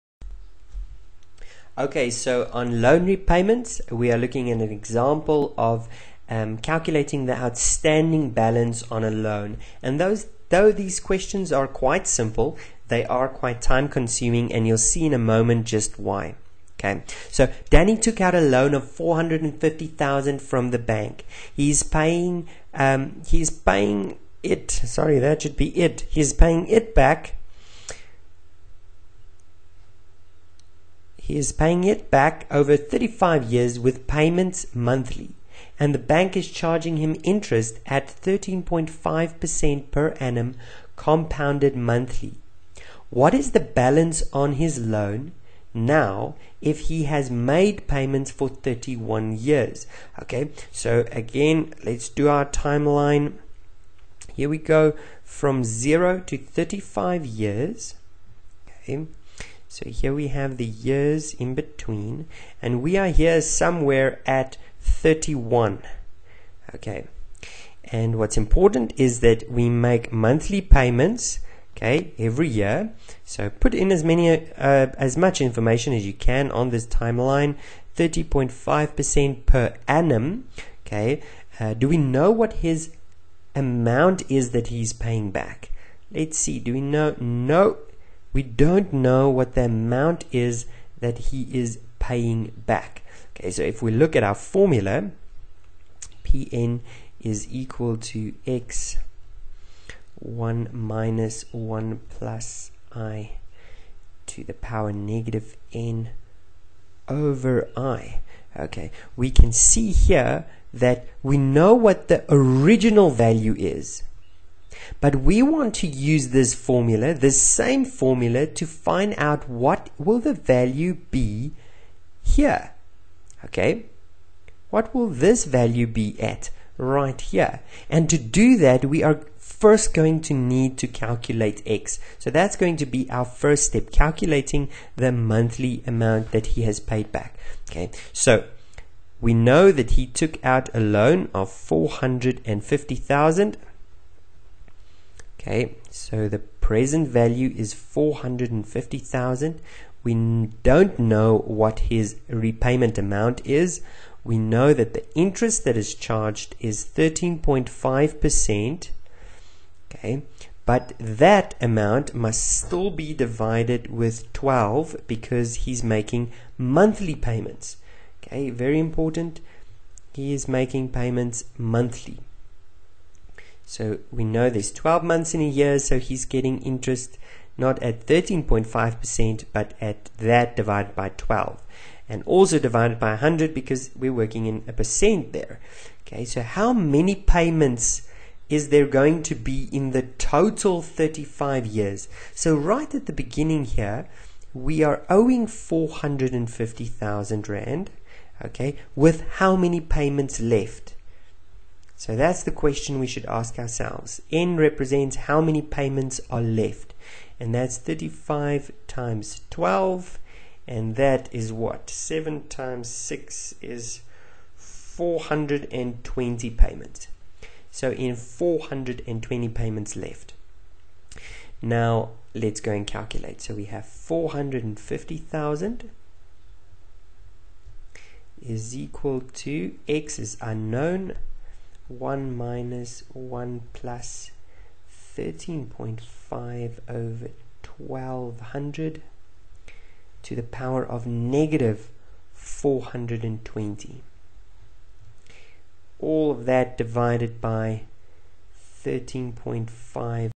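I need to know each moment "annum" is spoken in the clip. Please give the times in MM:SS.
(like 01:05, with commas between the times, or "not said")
00:40, 01:19.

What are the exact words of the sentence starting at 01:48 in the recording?
Okay, we can see here that we know what the original value is.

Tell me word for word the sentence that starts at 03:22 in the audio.
So that's the question we should ask ourselves.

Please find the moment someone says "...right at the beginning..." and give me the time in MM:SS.
03:12.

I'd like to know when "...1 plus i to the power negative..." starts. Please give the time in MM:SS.
01:41.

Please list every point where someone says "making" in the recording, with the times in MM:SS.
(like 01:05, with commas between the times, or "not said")
02:45, 02:50.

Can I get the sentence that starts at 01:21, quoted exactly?
Uh, do we know what his amount is that he's paying back?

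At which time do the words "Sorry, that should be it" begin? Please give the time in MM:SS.
00:24.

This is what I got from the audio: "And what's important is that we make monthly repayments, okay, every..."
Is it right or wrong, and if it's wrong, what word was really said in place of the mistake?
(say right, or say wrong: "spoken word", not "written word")
wrong: "payments", not "repayments".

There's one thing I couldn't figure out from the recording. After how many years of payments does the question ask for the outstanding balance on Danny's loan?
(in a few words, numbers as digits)
31 years.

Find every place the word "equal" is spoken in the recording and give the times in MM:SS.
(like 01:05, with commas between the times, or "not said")
01:37, 03:48.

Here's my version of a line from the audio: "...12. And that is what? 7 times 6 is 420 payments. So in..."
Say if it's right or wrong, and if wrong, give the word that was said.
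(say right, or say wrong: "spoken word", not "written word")
right.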